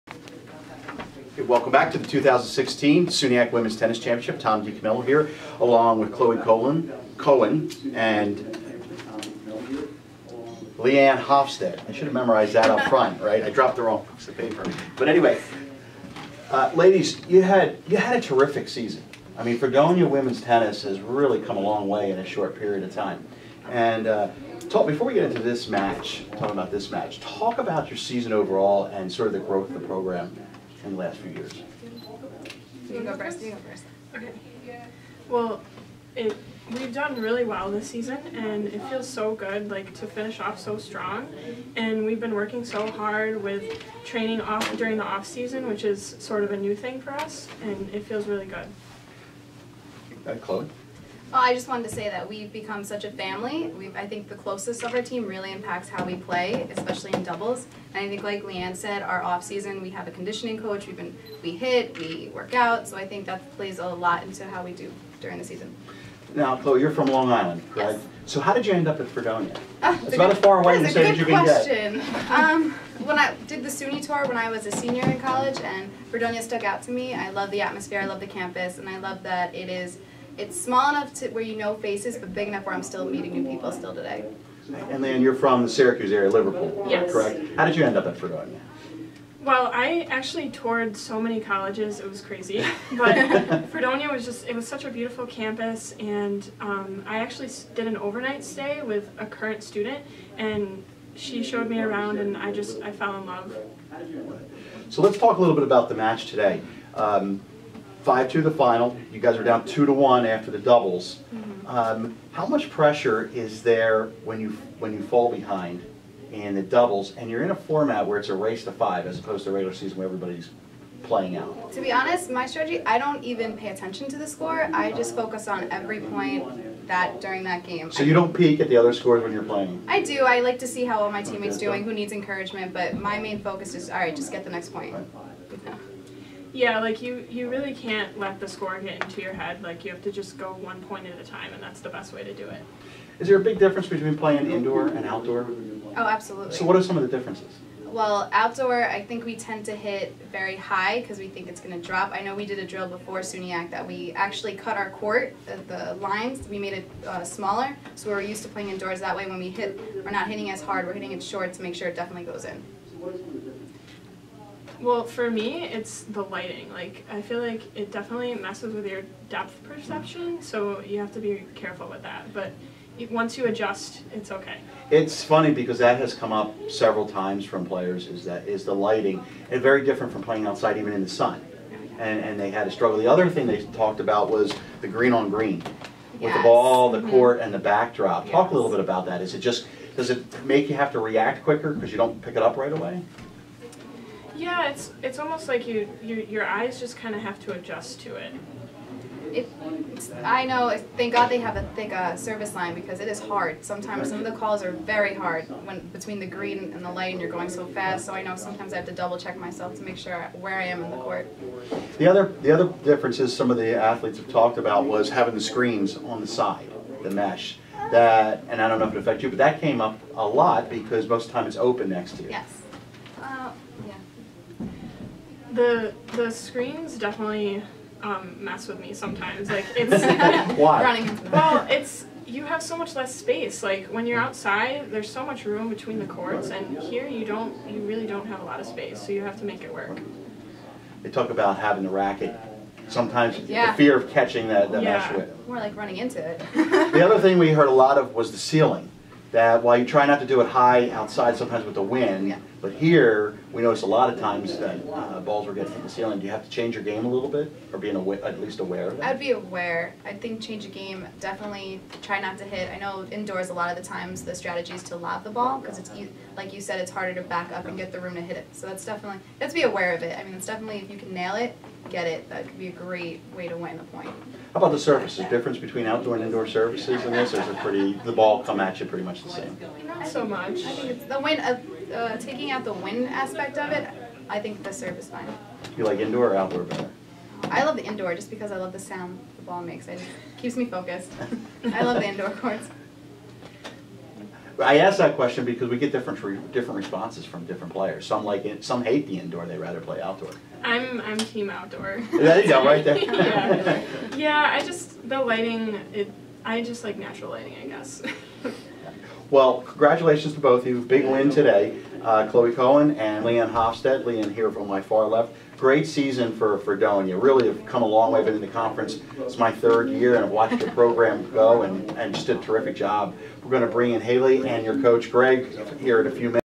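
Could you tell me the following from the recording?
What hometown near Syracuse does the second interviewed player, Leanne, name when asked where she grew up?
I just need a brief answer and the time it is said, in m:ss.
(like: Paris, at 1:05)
Liverpool, at 1:26.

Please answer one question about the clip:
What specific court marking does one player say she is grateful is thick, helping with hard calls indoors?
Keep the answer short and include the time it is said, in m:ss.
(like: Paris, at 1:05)
Service line, at 3:22.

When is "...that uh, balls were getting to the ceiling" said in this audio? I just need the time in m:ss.
4:14.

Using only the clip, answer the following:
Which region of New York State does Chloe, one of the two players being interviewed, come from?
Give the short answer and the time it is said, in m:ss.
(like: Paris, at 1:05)
Long Island, at 1:07.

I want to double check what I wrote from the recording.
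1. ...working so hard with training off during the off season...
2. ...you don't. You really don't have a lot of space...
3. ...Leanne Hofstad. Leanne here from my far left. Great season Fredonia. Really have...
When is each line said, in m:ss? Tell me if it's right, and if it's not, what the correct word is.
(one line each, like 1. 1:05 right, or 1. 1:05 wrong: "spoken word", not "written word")
1. 0:42 right
2. 3:57 right
3. 5:13 right.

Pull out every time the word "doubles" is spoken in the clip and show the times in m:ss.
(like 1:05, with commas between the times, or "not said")
0:57, 1:50, 1:56, 3:28.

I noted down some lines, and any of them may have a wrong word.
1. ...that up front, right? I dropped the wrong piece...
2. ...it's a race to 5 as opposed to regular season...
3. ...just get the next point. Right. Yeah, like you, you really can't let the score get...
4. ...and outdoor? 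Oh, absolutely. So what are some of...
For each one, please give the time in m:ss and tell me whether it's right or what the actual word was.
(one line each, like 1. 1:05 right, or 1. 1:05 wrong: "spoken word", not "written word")
1. 0:12 right
2. 1:58 right
3. 2:14 right
4. 2:24 right.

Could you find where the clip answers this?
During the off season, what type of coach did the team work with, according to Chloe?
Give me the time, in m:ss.
1:00.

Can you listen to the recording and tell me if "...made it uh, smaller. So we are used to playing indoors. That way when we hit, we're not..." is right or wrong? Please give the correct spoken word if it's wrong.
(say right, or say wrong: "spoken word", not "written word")
right.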